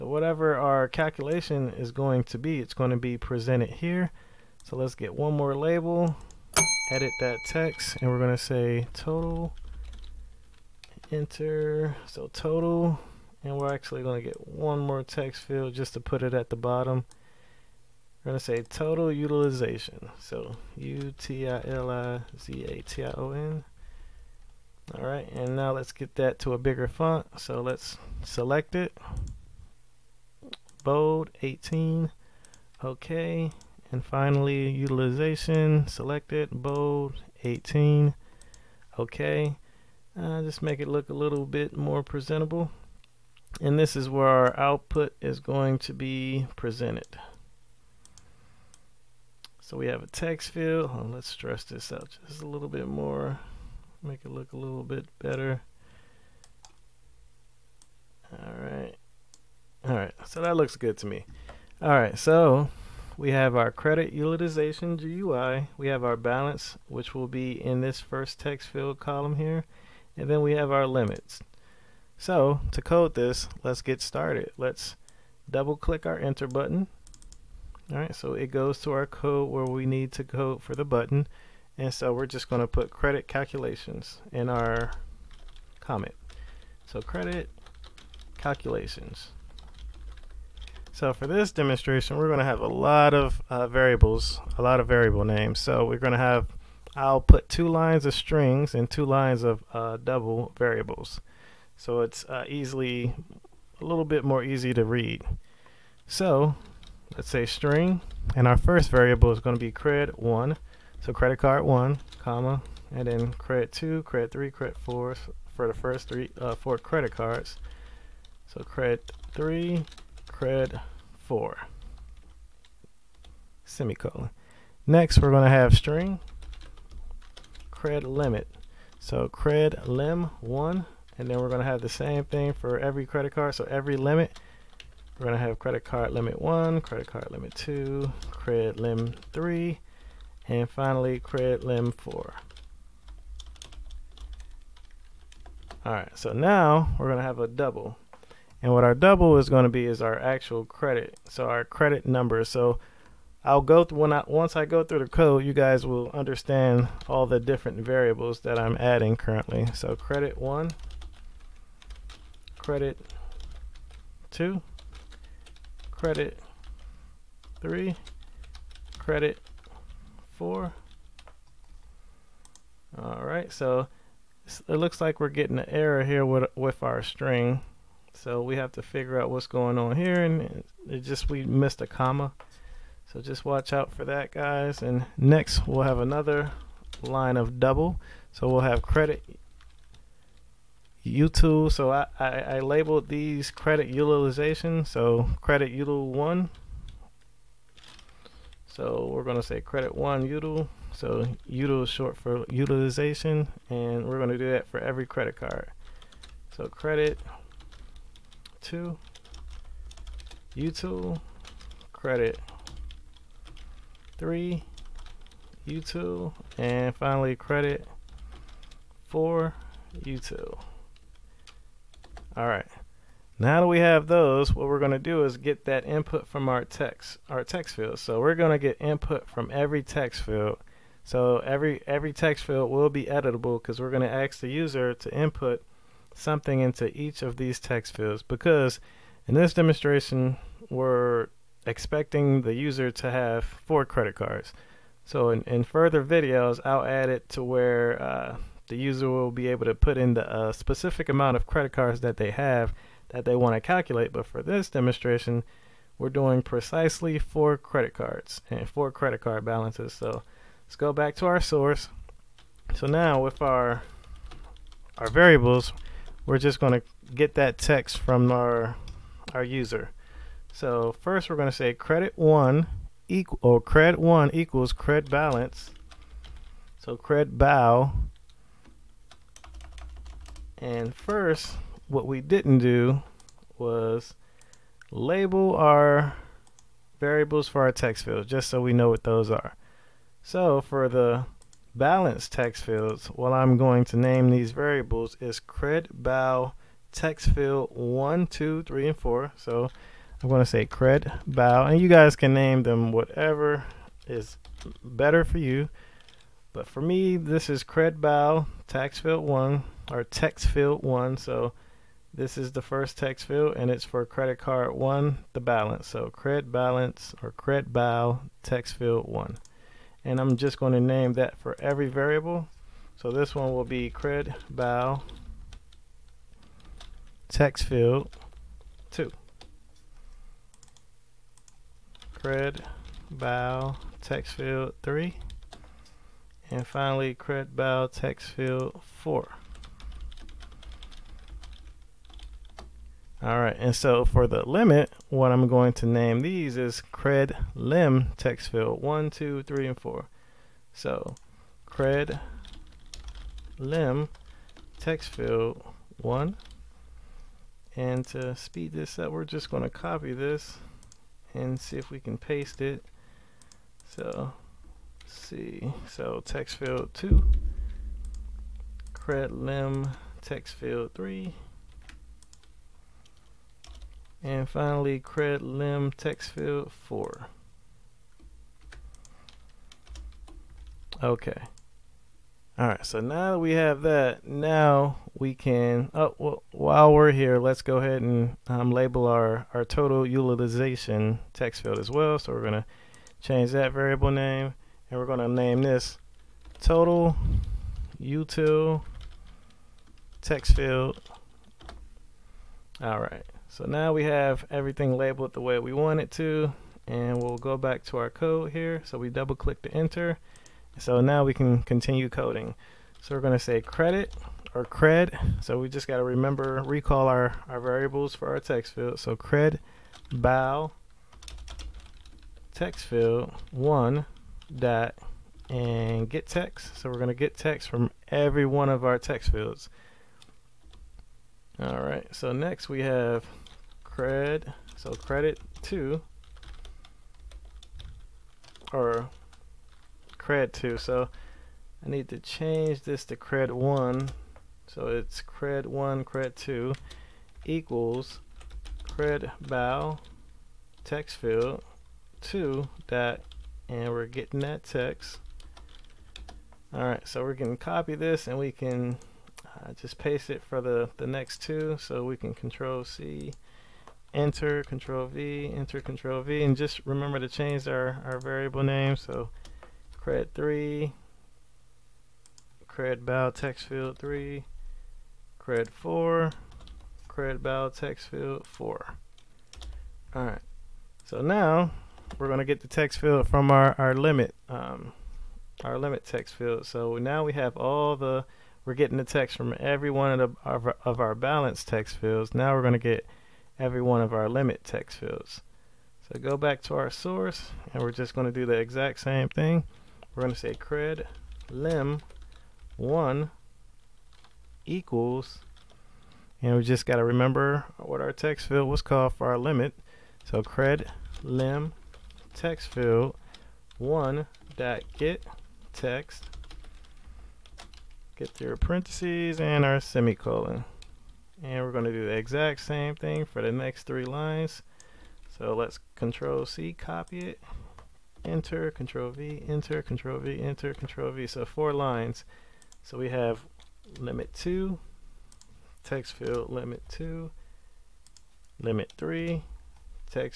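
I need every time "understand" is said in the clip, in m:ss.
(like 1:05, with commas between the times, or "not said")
2:36.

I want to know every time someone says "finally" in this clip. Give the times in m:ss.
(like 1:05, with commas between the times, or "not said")
0:34, 2:20, 3:36, 5:36, 6:14.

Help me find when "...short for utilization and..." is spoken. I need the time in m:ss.
3:21.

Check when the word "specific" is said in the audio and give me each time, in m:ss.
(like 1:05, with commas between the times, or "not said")
4:10.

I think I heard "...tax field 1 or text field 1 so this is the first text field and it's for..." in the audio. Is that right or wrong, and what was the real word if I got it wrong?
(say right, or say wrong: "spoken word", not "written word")
right.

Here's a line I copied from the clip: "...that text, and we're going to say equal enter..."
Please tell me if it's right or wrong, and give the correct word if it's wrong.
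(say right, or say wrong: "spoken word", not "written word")
wrong: "total", not "equal".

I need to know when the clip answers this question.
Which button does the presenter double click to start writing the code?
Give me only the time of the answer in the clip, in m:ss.
1:16.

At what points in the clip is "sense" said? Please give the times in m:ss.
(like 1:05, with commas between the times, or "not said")
not said.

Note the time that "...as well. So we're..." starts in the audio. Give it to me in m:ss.
6:31.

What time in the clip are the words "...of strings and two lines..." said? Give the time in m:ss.
1:38.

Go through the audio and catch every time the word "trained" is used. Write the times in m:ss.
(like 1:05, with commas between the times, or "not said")
not said.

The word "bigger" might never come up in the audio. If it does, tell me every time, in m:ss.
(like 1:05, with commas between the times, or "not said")
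0:26.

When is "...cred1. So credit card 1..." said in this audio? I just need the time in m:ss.
1:49.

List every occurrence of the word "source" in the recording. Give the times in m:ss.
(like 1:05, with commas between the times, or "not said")
4:21, 8:16.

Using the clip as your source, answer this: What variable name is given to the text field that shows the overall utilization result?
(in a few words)
total util text field.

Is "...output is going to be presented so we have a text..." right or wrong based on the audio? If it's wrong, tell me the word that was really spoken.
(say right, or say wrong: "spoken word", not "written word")
right.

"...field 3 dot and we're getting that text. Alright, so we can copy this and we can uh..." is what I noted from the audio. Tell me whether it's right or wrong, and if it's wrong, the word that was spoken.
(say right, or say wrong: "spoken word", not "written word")
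wrong: "2", not "3".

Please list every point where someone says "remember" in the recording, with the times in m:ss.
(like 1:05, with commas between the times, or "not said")
6:56, 7:46, 8:27.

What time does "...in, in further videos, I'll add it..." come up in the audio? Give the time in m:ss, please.
4:05.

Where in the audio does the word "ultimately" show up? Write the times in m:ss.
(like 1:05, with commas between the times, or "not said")
not said.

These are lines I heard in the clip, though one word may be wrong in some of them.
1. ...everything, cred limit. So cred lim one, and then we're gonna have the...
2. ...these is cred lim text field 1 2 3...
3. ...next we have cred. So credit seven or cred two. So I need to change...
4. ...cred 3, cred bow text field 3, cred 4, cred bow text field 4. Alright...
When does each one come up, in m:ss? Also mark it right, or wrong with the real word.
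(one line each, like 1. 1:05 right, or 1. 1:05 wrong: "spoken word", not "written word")
1. 2:05 wrong: "string", not "everything"
2. 5:46 right
3. 7:12 wrong: "two", not "seven"
4. 7:50 right.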